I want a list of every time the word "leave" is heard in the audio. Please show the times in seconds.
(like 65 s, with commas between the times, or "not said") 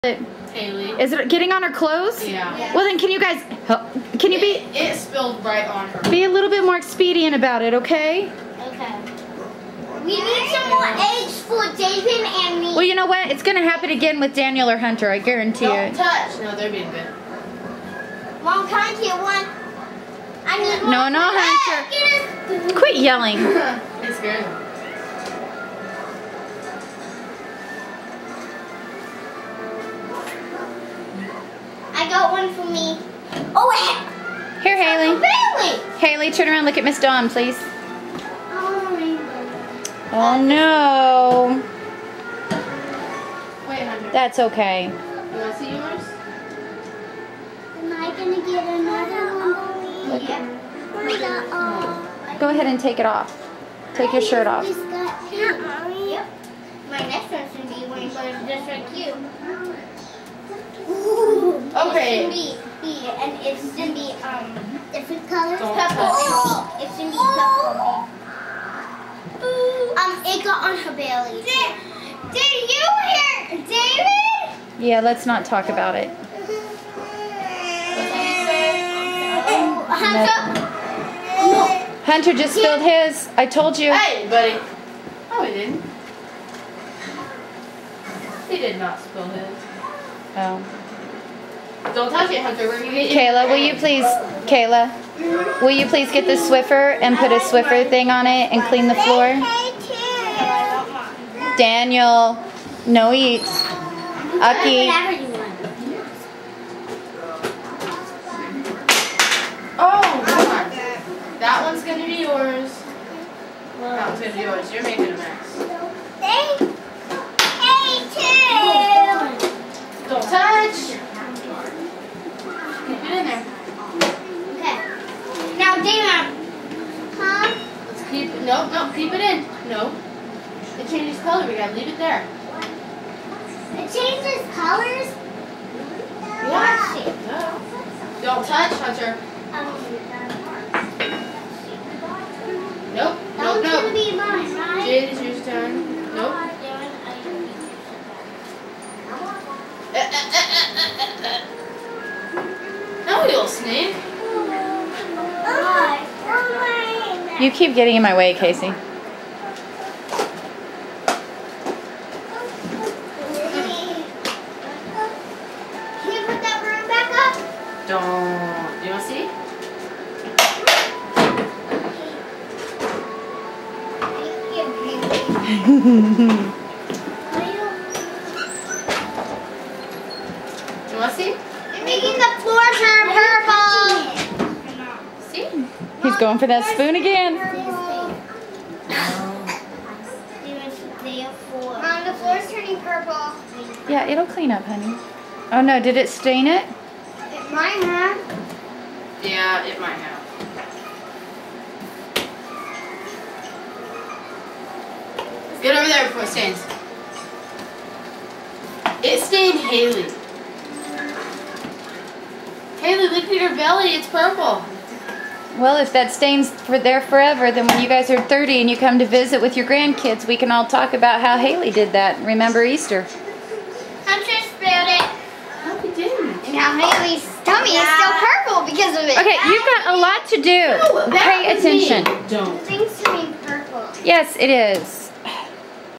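131 s.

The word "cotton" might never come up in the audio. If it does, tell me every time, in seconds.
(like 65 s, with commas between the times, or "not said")
not said.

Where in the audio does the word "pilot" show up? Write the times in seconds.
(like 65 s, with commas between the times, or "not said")
not said.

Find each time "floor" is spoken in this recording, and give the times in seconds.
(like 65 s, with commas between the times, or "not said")
98 s, 182 s, 192 s.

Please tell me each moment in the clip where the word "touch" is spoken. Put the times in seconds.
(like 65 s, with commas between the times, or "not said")
16 s, 92 s, 138 s.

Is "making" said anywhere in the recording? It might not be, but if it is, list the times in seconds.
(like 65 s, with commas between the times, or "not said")
114 s, 181 s.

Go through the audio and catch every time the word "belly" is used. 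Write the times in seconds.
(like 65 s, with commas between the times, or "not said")
70 s, 213 s.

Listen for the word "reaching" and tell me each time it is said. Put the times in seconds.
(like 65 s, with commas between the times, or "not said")
not said.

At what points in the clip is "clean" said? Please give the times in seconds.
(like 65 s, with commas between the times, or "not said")
98 s, 194 s.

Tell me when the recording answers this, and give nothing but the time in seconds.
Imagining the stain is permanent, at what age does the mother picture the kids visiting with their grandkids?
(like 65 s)
218 s.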